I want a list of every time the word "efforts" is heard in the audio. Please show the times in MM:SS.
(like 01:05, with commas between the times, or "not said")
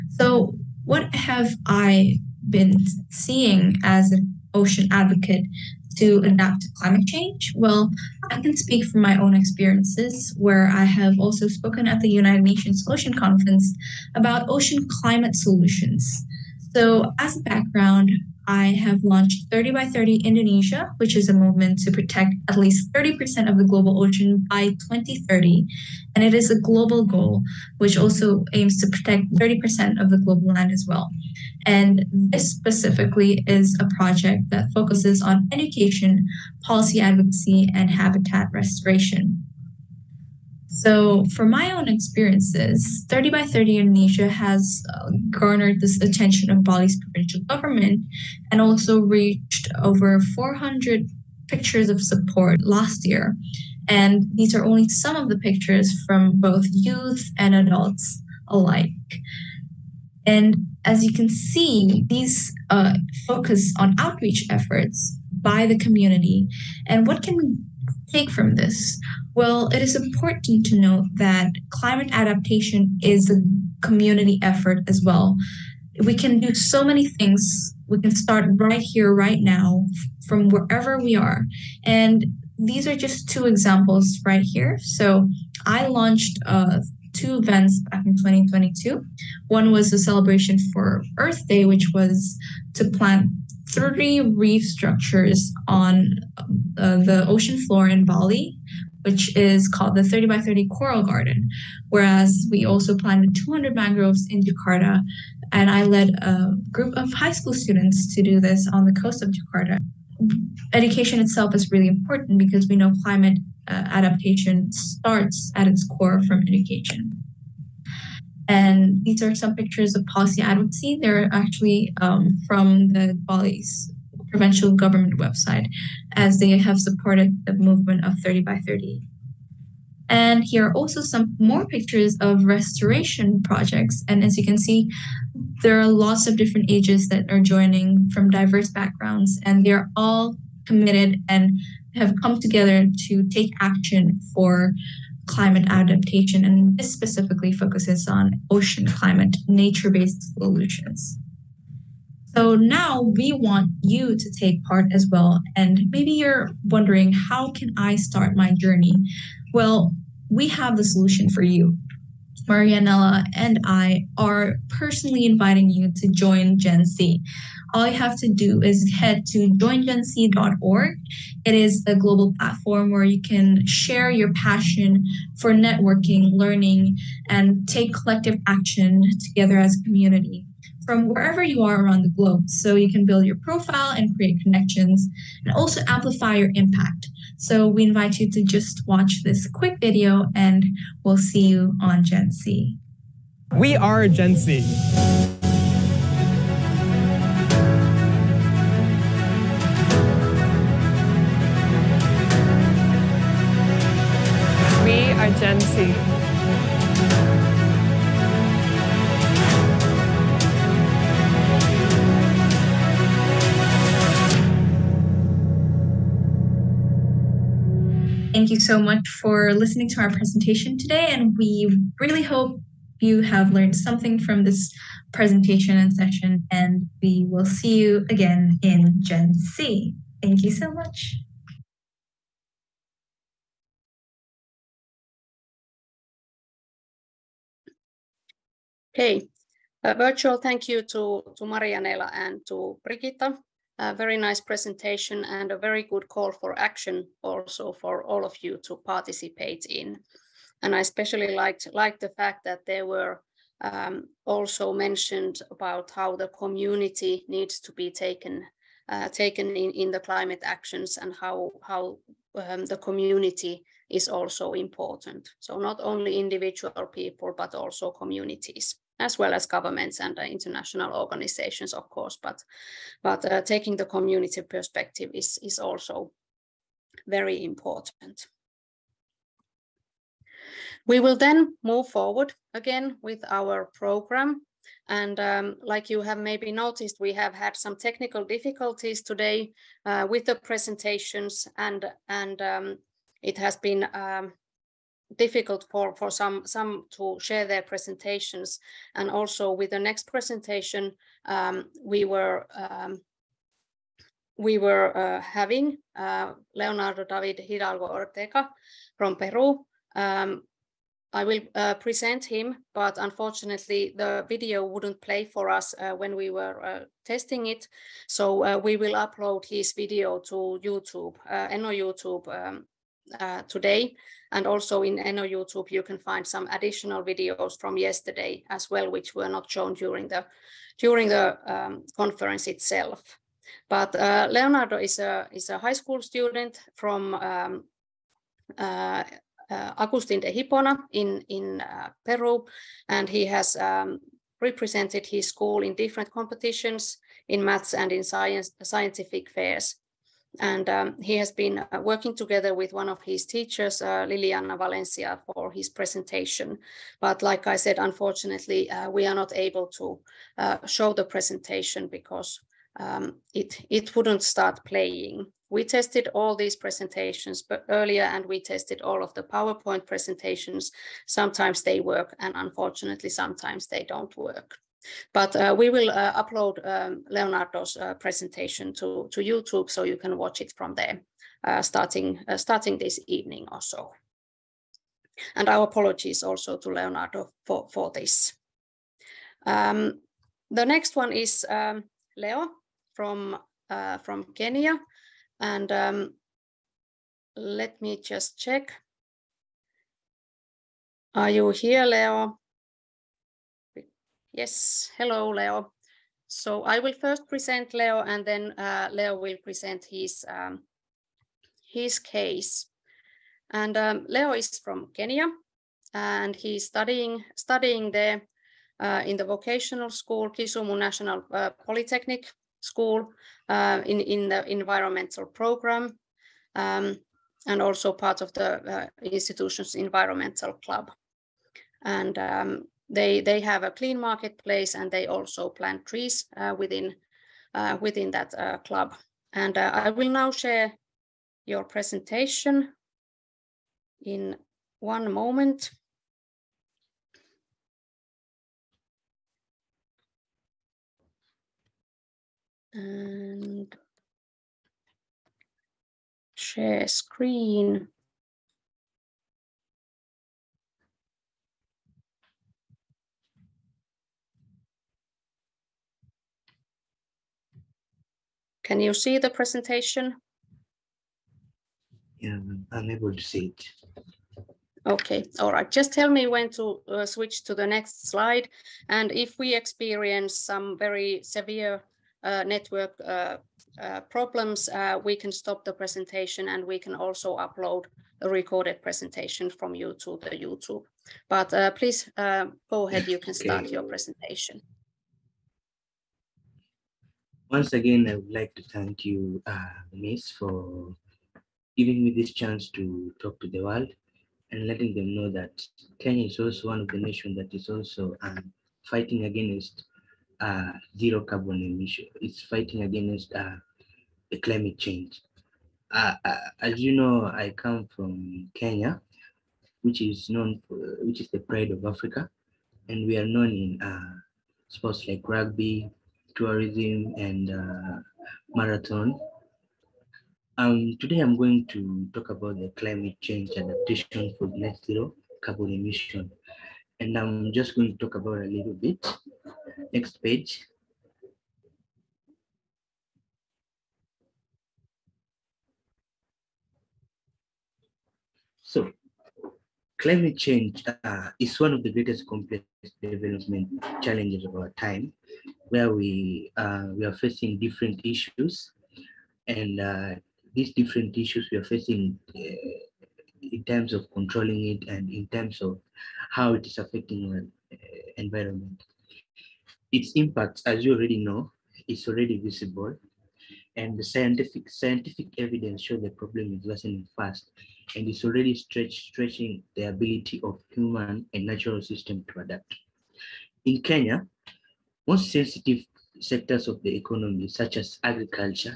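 01:04, 01:14.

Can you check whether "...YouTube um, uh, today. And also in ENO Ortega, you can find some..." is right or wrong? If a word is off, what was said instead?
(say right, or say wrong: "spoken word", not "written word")
wrong: "YouTube", not "Ortega".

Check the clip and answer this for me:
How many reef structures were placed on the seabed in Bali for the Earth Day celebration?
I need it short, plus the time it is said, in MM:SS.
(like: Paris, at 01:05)
3, at 01:33.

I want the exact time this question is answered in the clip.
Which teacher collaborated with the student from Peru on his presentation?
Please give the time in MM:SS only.
05:54.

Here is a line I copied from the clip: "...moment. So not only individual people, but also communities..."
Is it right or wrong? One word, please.
wrong.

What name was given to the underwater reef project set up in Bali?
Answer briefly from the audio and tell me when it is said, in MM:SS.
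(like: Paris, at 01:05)
30 by 30 Coral Garden, at 01:40.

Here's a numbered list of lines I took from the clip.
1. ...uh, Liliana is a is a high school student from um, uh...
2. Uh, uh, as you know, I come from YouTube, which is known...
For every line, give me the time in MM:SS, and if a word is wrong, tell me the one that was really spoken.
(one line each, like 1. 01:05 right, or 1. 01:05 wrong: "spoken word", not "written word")
1. 05:33 wrong: "Leonardo", not "Liliana"
2. 08:35 wrong: "Kenya", not "YouTube".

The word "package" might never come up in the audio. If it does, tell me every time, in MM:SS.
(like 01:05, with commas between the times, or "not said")
not said.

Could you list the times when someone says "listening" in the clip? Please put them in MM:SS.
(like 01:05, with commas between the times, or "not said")
03:39.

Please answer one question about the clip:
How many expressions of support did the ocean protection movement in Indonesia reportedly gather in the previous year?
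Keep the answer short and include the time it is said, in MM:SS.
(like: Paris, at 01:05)
400, at 00:50.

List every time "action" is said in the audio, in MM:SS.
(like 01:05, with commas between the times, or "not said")
02:23, 02:58, 04:06, 04:20.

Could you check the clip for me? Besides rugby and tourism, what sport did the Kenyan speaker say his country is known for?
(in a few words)
marathon.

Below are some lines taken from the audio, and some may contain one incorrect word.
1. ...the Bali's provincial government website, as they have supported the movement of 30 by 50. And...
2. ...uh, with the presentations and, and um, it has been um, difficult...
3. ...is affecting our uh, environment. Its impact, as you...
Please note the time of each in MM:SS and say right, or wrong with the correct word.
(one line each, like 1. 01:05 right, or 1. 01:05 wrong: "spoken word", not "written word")
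1. 02:02 wrong: "30", not "50"
2. 04:49 right
3. 09:26 right.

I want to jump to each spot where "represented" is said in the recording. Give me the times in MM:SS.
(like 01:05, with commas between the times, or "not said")
05:44.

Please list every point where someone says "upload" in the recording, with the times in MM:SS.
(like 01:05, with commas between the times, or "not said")
05:18, 06:16, 08:07.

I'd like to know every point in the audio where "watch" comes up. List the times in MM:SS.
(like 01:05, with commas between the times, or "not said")
03:08, 06:20.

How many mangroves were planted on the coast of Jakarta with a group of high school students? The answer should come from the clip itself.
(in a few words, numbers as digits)
200.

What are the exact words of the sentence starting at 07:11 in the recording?
And um, they, they have a clean marketplace and they also plant trees uh, within, uh, within that uh, club.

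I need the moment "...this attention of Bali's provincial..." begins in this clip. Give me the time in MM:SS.
00:45.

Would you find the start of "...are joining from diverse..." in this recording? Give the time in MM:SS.
02:17.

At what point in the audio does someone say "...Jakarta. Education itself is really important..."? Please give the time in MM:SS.
01:49.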